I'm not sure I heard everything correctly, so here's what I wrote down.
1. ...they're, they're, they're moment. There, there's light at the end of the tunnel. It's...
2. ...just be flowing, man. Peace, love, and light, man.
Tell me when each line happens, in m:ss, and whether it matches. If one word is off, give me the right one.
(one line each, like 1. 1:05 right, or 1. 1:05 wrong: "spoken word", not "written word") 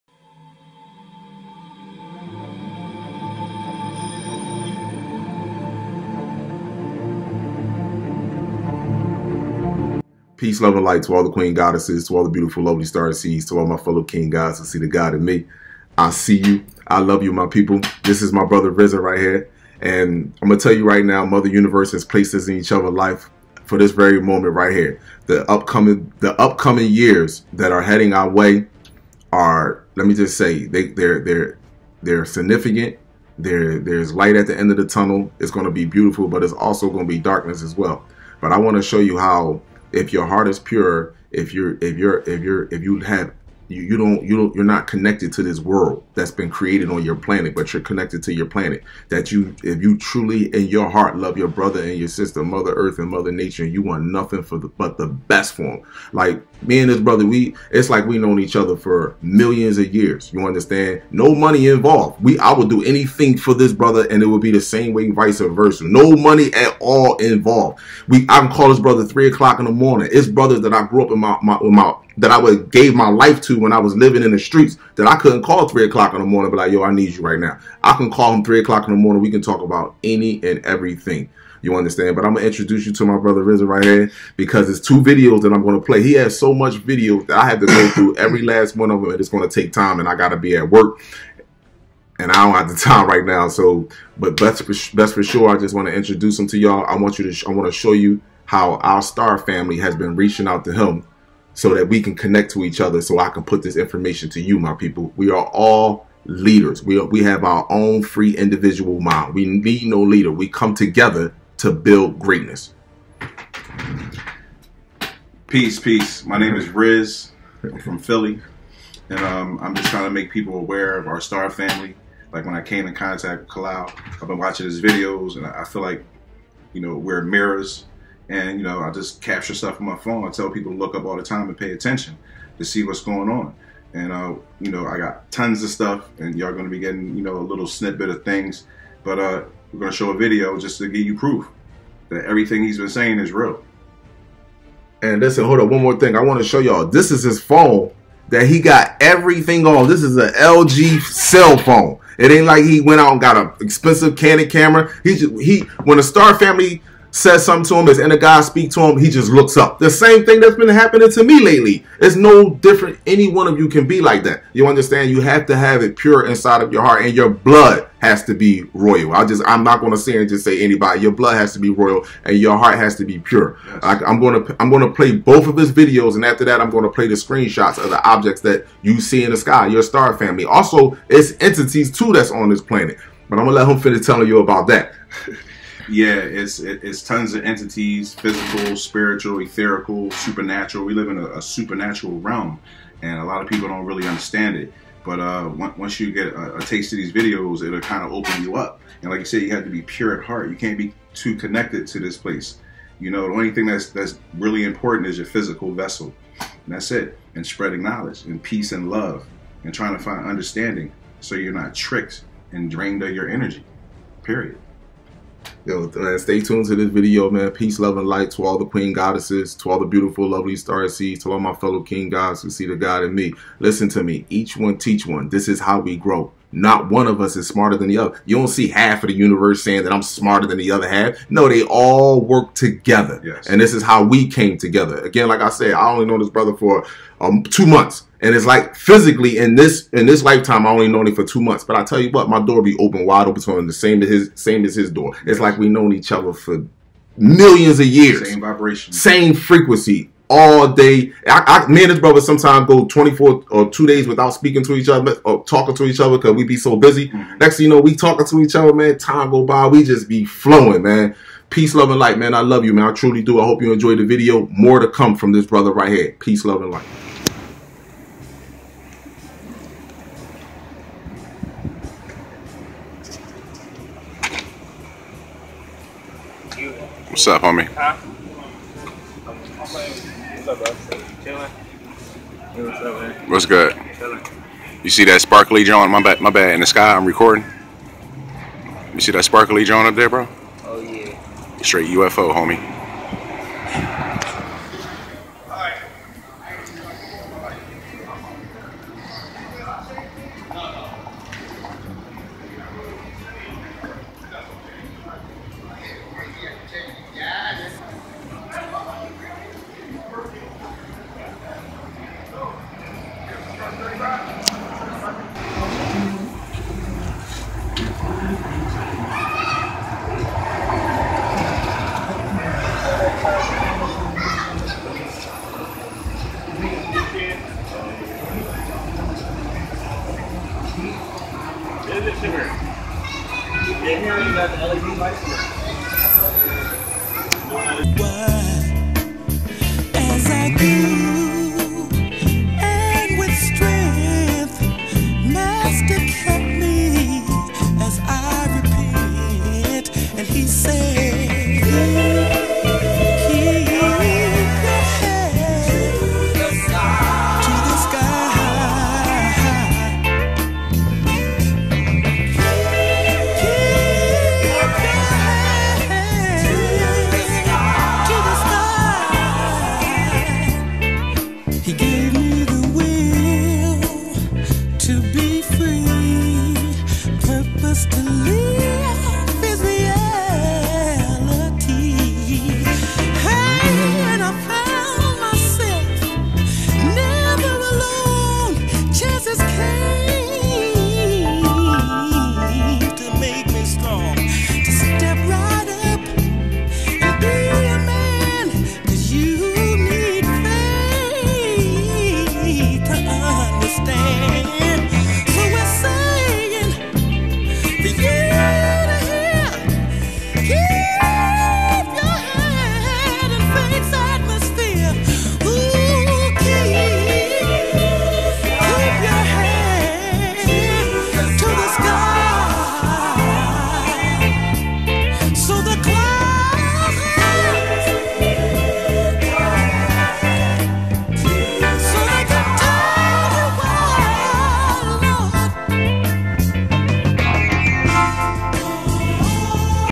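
1. 0:30 wrong: "significant", not "moment"
2. 4:19 right.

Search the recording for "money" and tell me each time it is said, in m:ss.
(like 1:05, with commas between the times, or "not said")
1:01, 1:06.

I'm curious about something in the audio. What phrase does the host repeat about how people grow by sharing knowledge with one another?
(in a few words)
Each one teach one.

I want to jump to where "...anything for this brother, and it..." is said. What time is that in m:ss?
1:02.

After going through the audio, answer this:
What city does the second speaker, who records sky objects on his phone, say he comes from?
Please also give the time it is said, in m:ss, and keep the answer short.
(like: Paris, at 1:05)
Philly, at 1:57.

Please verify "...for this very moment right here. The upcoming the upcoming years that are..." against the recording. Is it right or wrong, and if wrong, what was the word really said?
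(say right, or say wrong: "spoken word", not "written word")
right.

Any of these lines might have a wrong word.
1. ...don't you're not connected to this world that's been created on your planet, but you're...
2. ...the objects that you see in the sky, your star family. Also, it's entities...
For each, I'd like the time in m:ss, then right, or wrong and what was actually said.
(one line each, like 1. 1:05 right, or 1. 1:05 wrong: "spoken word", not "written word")
1. 0:44 right
2. 2:57 right.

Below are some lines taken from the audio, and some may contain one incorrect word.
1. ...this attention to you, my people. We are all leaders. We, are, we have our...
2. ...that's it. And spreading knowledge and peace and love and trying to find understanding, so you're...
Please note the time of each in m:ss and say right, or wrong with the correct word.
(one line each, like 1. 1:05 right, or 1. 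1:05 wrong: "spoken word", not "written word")
1. 1:43 wrong: "information", not "attention"
2. 3:26 right.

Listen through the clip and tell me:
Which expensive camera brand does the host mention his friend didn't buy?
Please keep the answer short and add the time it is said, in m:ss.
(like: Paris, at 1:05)
Canon, at 2:34.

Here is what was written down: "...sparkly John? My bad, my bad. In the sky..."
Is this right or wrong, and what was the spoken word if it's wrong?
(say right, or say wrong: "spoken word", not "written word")
right.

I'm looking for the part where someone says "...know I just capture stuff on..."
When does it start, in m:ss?
2:08.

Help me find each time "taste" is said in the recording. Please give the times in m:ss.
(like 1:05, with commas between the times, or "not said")
3:16.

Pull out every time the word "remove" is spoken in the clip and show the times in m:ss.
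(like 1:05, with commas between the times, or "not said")
not said.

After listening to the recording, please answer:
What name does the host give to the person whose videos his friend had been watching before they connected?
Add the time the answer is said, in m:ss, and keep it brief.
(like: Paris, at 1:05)
Kalau, at 2:03.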